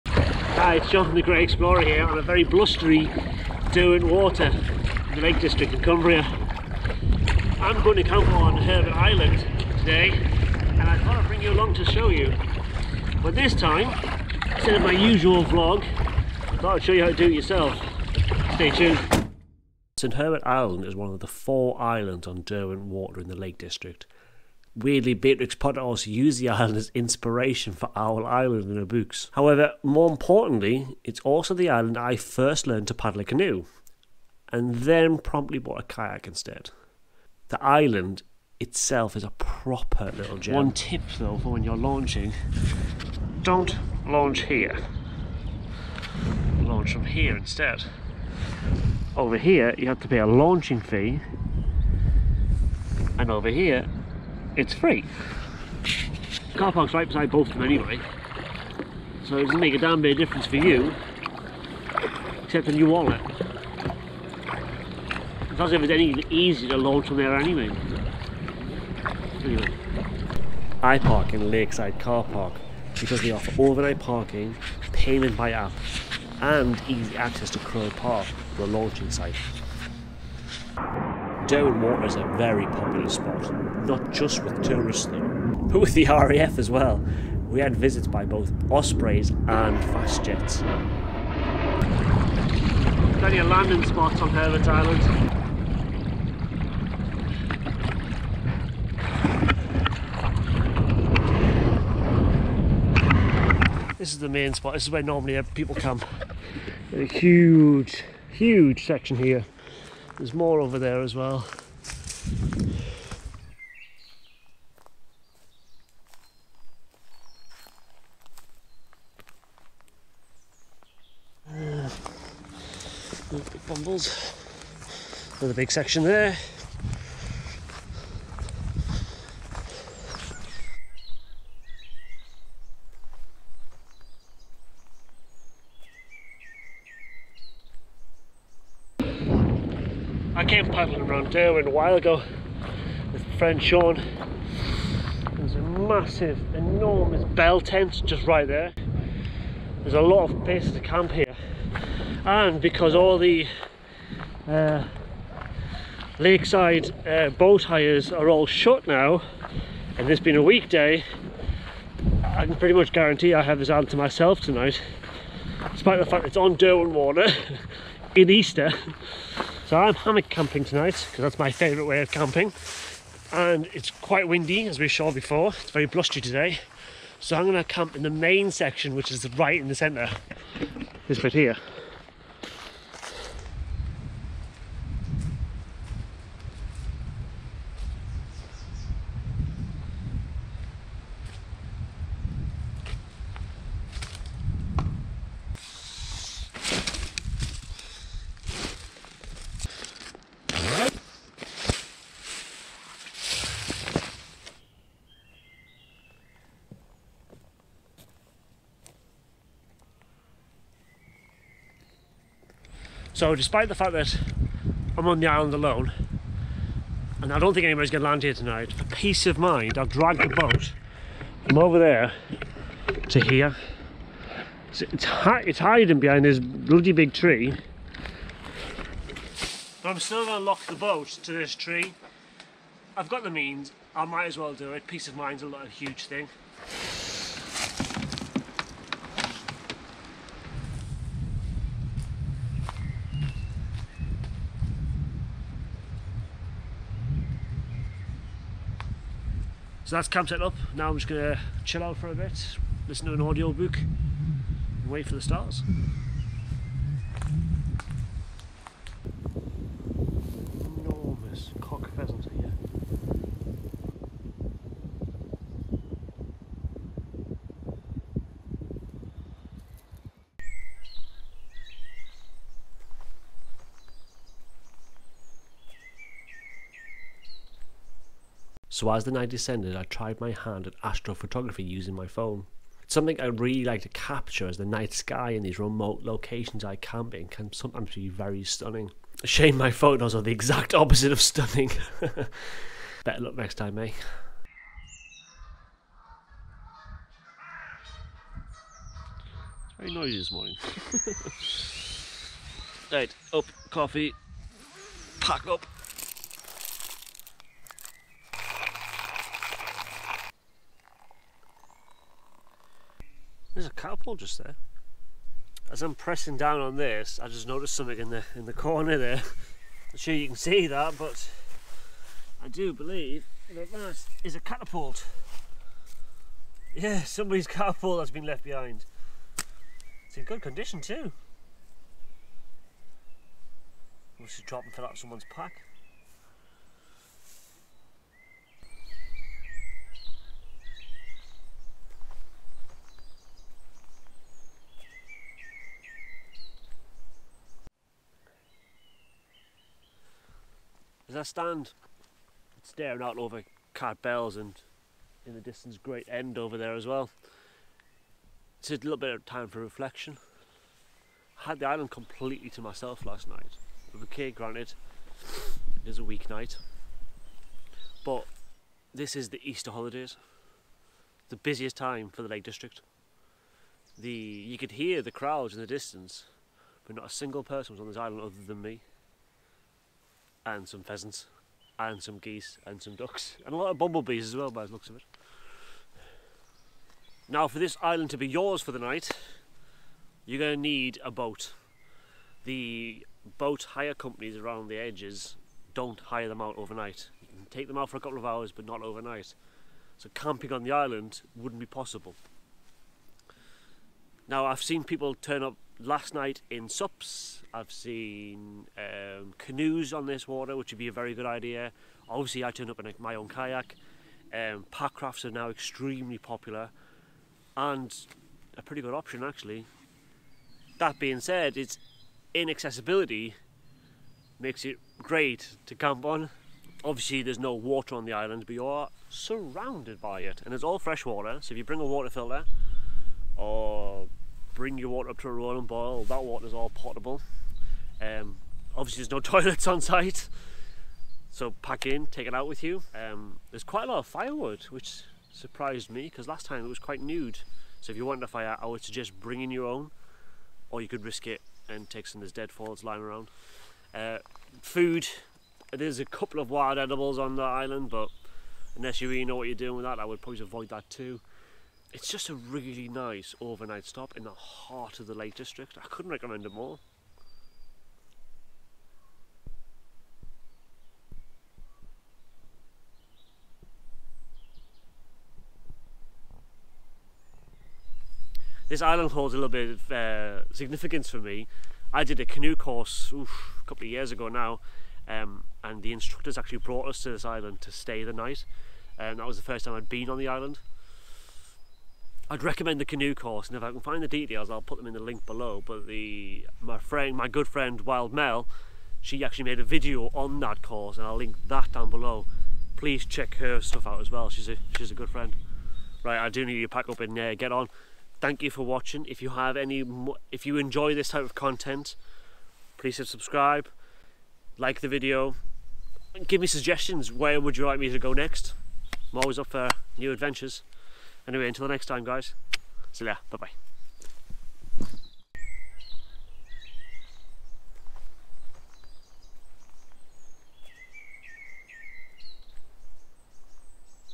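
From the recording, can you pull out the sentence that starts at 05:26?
Yeah, somebody's catapult that's been left behind.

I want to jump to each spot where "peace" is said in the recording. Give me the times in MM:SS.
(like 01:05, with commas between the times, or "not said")
03:38, 03:54.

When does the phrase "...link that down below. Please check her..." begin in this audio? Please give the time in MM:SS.
08:21.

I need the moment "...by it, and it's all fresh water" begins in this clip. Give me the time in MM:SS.
07:10.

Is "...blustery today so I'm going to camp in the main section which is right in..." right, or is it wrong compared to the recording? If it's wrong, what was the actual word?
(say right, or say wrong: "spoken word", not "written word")
right.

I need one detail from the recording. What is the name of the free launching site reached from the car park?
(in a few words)
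Crow Park.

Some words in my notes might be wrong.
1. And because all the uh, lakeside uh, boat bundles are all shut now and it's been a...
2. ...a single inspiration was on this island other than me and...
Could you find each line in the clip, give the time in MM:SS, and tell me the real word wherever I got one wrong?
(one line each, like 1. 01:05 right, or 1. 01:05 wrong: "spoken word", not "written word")
1. 02:32 wrong: "hires", not "bundles"
2. 06:17 wrong: "person", not "inspiration".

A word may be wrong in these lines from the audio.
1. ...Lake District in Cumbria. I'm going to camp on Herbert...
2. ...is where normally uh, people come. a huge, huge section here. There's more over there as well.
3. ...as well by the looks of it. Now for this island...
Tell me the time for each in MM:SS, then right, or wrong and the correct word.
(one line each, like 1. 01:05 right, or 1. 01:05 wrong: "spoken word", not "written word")
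1. 00:05 right
2. 01:44 right
3. 06:24 right.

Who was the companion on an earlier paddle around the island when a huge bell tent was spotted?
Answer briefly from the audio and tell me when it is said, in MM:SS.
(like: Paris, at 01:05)
Sean, at 02:23.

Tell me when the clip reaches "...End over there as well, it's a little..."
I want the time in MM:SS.
05:56.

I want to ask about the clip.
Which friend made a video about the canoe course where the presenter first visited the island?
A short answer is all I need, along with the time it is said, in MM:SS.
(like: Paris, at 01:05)
Wild Mel, at 08:17.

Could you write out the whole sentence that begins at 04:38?
So as the night descended, I tried my hand at astrophotography using my phone.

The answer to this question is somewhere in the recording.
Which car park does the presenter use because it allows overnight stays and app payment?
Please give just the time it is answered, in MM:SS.
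01:11.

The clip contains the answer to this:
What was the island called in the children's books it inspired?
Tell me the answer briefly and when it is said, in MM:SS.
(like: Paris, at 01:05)
Owl Island, at 00:27.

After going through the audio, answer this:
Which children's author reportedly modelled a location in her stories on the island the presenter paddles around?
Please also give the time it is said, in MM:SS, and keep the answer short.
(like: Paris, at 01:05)
Beatrix Potter, at 00:25.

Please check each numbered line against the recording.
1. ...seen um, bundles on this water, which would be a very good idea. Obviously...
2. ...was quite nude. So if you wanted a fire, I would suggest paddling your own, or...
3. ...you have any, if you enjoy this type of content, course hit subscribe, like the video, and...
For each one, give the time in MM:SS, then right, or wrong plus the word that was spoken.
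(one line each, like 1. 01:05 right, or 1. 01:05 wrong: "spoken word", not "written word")
1. 06:47 wrong: "canoes", not "bundles"
2. 07:26 wrong: "bringing", not "paddling"
3. 08:29 wrong: "please", not "course".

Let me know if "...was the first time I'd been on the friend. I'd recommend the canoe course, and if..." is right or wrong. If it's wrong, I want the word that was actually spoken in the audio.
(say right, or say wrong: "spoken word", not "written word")
wrong: "island", not "friend".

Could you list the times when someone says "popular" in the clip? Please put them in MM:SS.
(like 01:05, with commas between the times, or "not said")
01:22, 06:56.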